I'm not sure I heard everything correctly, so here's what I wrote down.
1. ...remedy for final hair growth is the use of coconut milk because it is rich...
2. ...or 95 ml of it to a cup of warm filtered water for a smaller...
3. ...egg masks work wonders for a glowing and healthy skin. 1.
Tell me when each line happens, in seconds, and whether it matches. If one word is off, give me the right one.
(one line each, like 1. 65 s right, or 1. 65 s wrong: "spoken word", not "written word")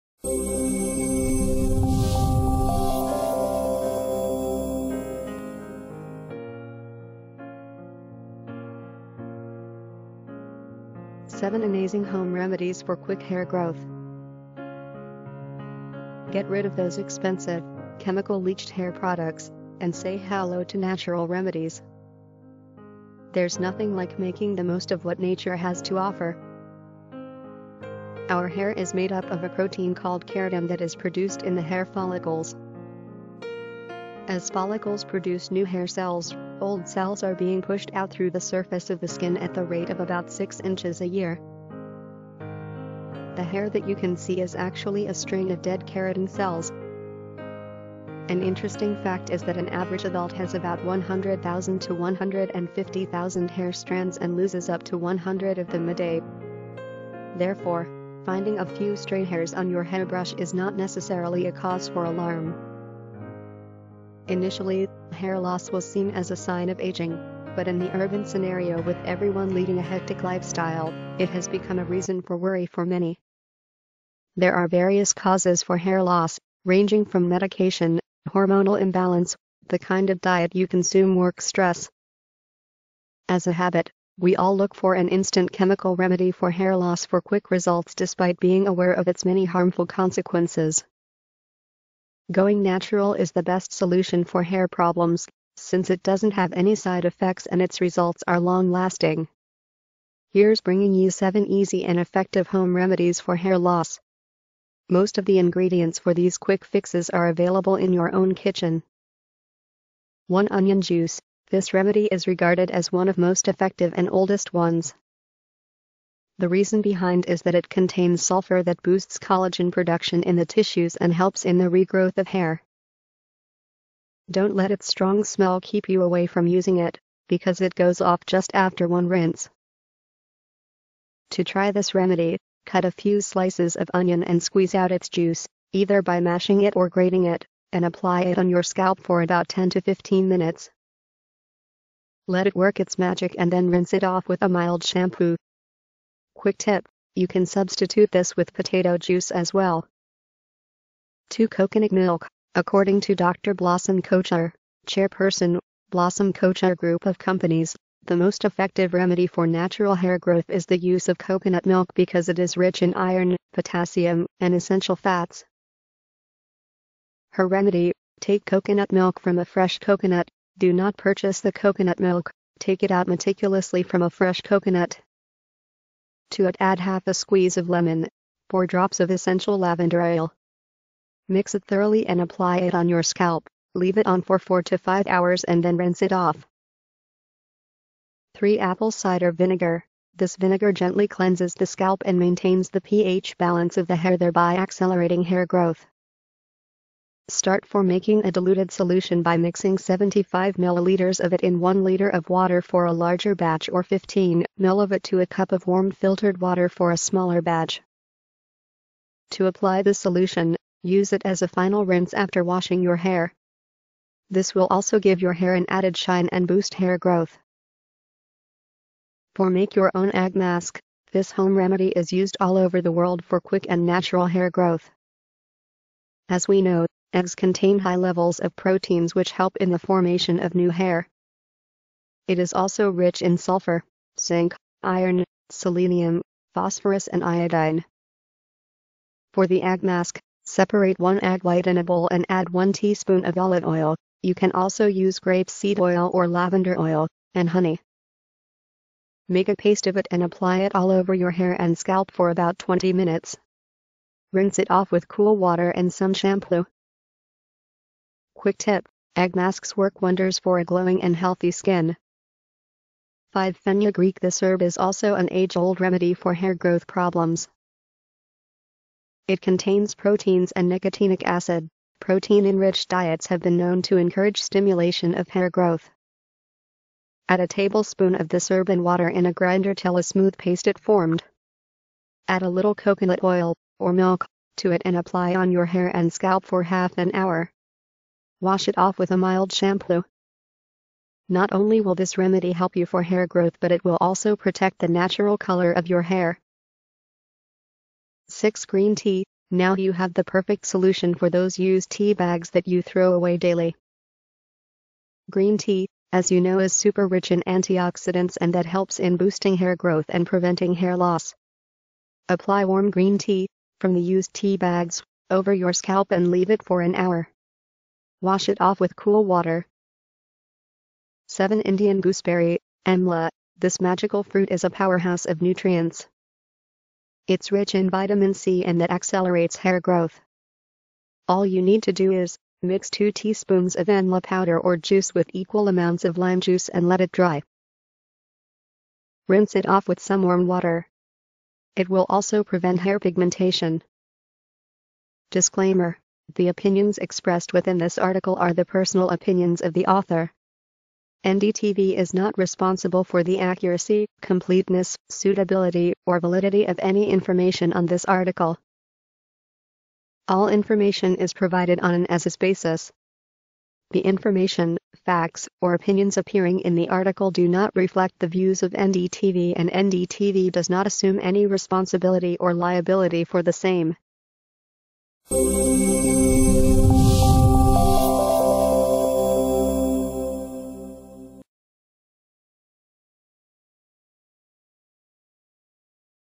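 1. 158 s wrong: "natural", not "final"
2. 203 s wrong: "15", not "95"
3. 259 s wrong: "5", not "1".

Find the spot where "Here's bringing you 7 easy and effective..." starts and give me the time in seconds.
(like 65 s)
100 s.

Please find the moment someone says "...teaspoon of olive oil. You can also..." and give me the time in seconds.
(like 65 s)
242 s.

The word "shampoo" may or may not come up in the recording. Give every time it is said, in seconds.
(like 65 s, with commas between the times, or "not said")
144 s, 256 s, 289 s.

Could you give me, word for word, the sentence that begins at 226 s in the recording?
As we know, Eggs contain high levels of proteins which help in the formation of new hair.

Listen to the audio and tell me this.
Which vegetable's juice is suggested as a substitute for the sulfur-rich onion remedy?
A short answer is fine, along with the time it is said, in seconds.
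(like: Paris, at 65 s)
potato, at 148 s.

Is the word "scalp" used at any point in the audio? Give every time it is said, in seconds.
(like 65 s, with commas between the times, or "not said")
138 s, 183 s, 191 s, 251 s, 286 s, 315 s.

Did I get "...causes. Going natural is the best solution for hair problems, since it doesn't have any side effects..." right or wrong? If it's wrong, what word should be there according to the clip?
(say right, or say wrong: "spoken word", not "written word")
wrong: "consequences", not "causes".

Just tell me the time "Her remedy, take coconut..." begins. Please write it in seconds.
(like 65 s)
167 s.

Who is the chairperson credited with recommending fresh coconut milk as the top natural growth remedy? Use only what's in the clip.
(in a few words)
Dr. Blossom Kochhar.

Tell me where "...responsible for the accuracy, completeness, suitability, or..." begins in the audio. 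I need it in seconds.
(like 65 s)
352 s.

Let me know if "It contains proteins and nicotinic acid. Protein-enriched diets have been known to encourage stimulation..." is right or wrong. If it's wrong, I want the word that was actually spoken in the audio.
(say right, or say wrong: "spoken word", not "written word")
right.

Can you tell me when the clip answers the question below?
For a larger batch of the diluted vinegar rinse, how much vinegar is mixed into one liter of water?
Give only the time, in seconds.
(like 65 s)
199 s.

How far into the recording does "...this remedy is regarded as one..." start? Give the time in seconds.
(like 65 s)
111 s.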